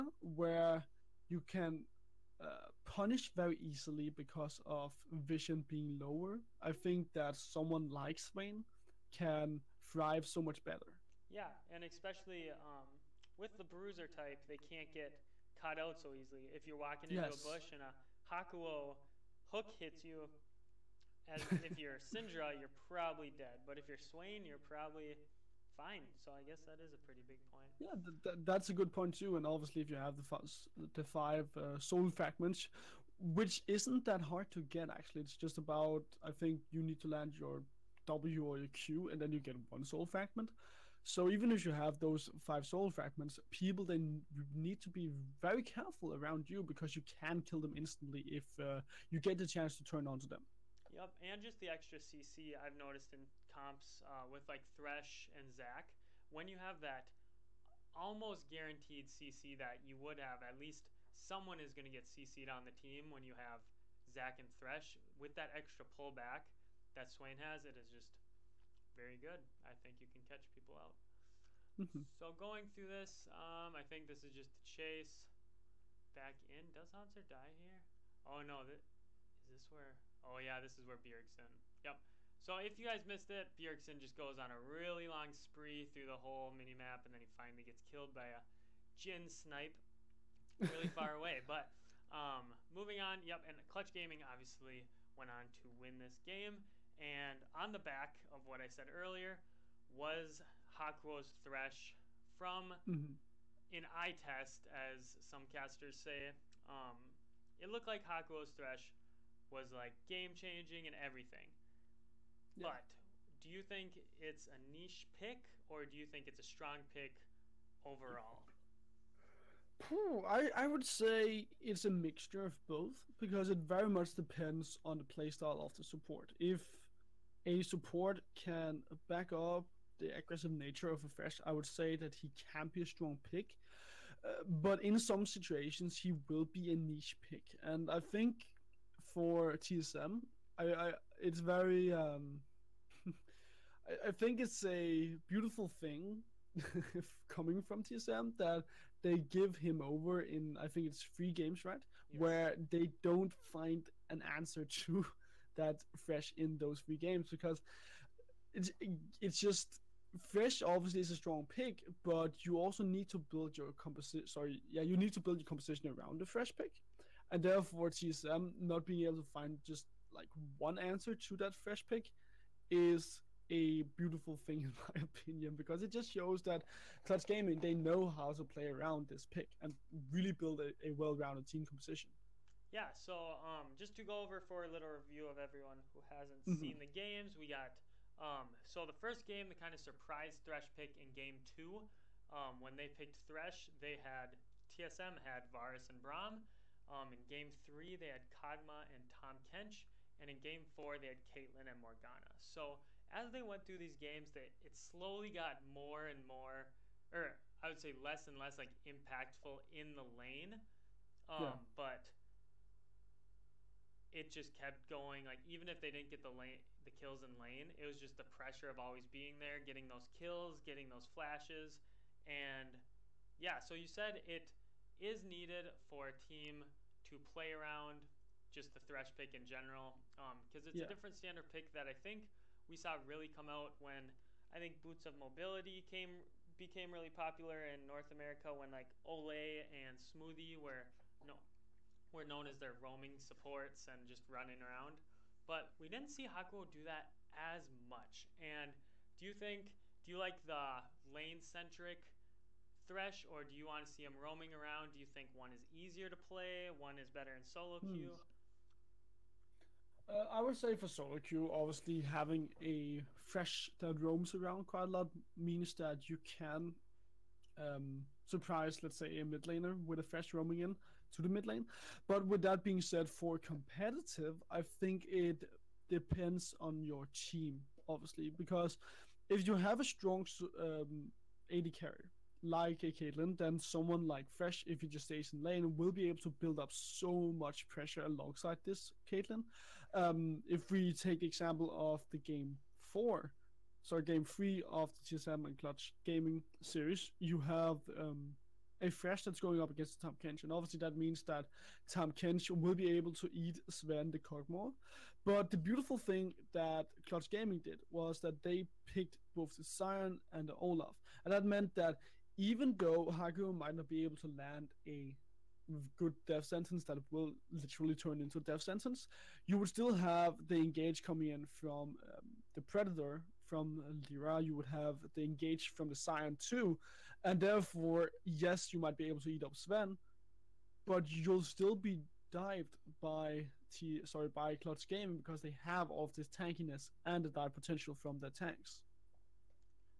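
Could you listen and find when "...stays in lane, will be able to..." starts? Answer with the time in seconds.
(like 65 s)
285 s.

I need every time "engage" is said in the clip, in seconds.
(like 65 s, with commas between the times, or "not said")
320 s, 325 s.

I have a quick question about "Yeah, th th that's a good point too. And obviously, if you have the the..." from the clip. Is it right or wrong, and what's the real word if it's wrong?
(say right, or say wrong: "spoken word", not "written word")
right.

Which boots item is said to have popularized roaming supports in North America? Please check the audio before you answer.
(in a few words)
Boots of Mobility.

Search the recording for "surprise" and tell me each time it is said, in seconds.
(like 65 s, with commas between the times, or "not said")
189 s, 268 s.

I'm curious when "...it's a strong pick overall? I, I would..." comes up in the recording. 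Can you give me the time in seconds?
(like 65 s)
116 s.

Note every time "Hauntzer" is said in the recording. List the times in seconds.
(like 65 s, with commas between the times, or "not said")
76 s.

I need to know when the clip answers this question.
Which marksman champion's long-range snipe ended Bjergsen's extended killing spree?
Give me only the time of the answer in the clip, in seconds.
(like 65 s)
88 s.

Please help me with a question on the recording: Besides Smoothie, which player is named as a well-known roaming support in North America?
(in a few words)
Olleh.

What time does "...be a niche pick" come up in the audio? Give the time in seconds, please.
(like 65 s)
136 s.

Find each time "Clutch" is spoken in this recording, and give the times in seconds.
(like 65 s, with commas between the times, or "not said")
93 s, 177 s, 295 s, 307 s, 334 s.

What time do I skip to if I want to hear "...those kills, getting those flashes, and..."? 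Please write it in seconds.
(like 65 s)
219 s.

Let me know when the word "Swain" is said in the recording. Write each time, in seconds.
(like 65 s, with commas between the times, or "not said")
8 s, 23 s, 67 s.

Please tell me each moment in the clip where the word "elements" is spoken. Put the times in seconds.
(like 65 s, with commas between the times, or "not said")
not said.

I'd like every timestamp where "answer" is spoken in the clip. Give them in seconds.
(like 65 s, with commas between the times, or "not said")
154 s, 170 s.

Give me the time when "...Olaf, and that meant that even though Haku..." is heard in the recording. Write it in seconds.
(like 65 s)
310 s.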